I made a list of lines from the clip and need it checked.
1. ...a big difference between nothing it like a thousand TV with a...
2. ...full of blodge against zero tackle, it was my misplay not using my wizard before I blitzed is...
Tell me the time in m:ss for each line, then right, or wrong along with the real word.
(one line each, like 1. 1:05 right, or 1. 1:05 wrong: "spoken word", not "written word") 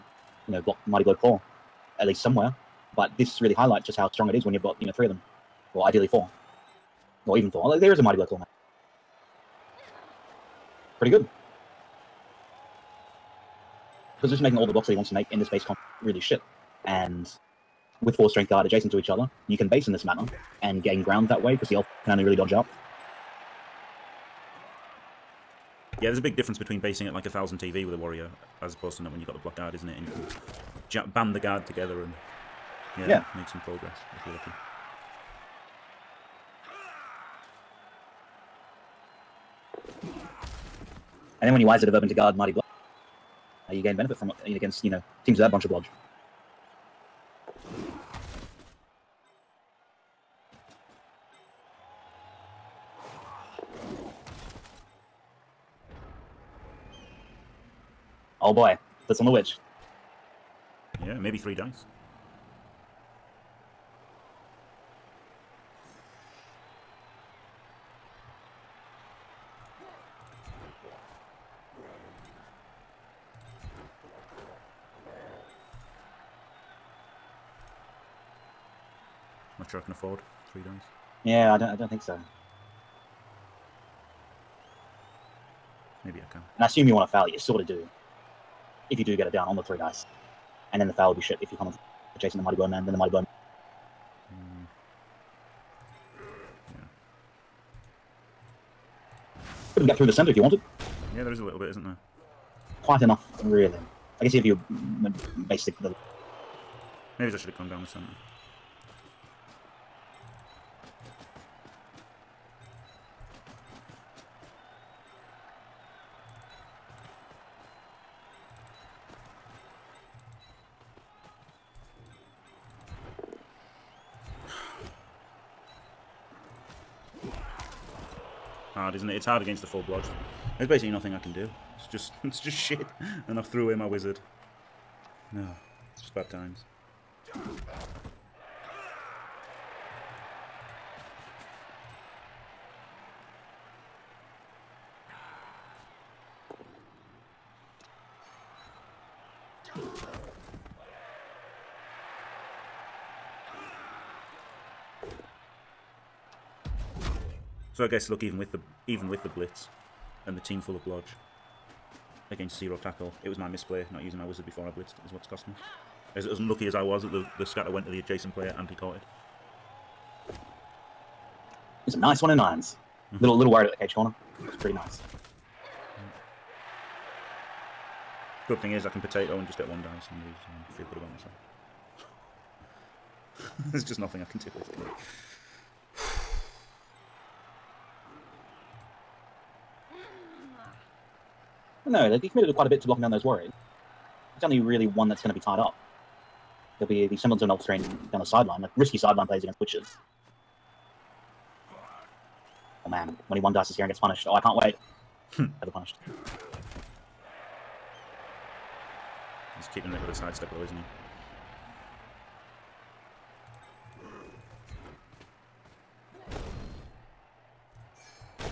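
1. 0:26 wrong: "basing", not "nothing"
2. 2:40 right.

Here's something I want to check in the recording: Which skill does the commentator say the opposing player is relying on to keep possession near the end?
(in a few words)
sidestep.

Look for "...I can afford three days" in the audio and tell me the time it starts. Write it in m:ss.
1:19.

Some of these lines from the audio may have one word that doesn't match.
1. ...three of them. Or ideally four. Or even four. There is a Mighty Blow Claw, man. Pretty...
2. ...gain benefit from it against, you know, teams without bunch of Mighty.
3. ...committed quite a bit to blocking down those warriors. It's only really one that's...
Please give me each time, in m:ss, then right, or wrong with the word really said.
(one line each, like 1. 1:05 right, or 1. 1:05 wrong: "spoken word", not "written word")
1. 0:04 right
2. 0:43 wrong: "Blodge", not "Mighty"
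3. 3:12 right.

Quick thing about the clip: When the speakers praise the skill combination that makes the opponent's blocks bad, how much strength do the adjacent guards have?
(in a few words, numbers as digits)
4.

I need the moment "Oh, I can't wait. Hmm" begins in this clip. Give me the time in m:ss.
3:24.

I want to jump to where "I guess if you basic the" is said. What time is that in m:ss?
1:44.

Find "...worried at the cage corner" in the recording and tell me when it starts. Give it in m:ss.
2:53.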